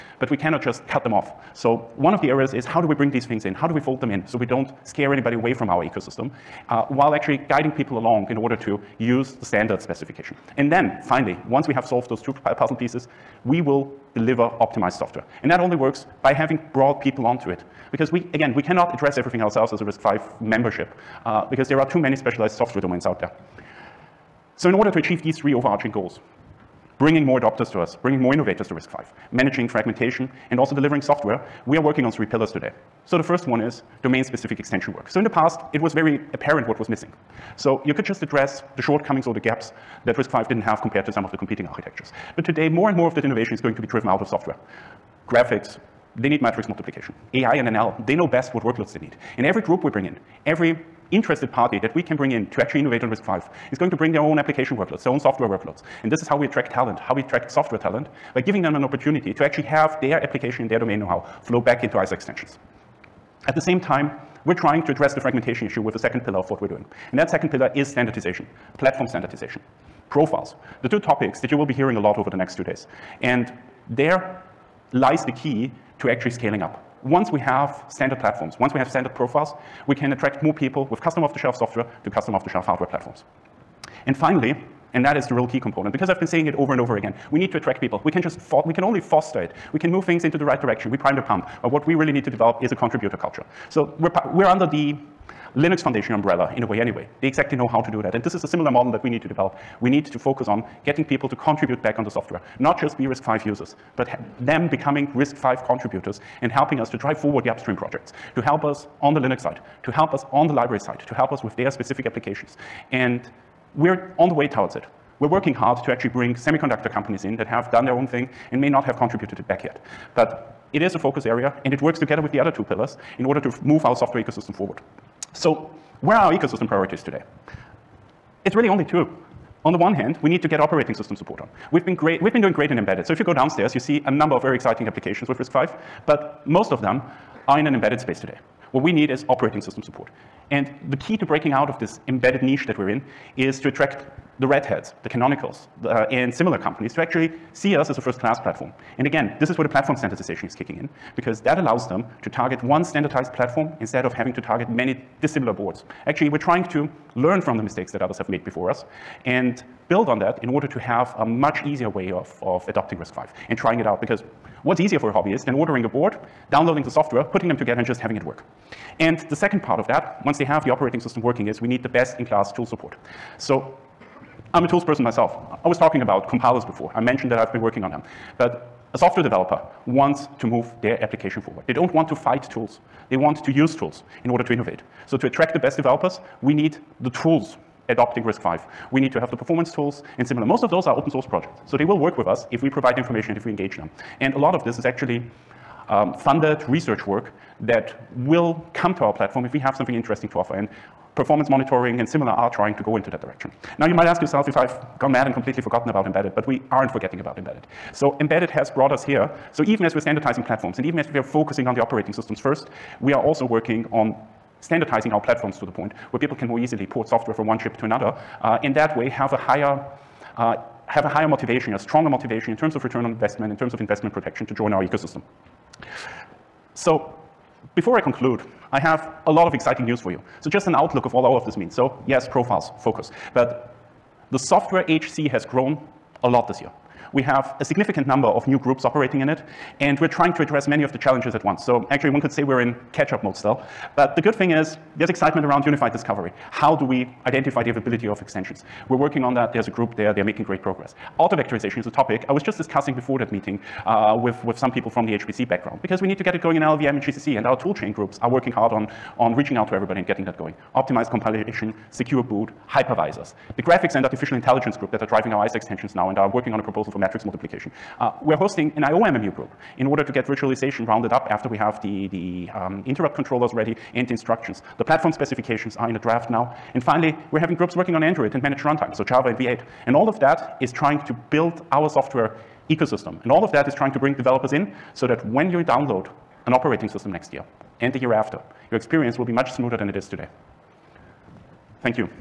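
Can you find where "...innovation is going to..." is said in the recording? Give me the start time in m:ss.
0:43.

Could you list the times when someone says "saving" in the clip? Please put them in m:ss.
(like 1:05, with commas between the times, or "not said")
not said.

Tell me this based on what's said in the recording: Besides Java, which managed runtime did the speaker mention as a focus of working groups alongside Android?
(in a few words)
V8.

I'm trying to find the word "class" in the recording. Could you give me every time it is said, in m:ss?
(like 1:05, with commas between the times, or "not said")
2:27, 2:51.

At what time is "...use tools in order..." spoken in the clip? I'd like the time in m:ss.
3:03.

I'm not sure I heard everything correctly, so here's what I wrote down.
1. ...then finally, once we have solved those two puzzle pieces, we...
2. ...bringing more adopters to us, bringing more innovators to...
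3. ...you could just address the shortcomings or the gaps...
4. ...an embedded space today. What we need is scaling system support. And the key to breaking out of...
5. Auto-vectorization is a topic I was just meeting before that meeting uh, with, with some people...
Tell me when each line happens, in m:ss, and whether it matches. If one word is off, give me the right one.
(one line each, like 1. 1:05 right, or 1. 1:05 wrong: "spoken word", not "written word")
1. 0:10 right
2. 0:26 right
3. 0:37 right
4. 2:17 wrong: "operating", not "scaling"
5. 4:11 wrong: "discussing", not "meeting".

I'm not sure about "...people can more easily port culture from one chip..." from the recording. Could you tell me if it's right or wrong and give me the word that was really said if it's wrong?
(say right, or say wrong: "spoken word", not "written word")
wrong: "software", not "culture".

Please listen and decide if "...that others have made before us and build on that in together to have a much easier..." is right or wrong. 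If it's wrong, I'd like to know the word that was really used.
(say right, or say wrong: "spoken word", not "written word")
wrong: "order", not "together".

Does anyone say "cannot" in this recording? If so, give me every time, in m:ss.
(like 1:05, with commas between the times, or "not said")
0:00, 0:18.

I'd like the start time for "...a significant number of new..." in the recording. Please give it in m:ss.
3:57.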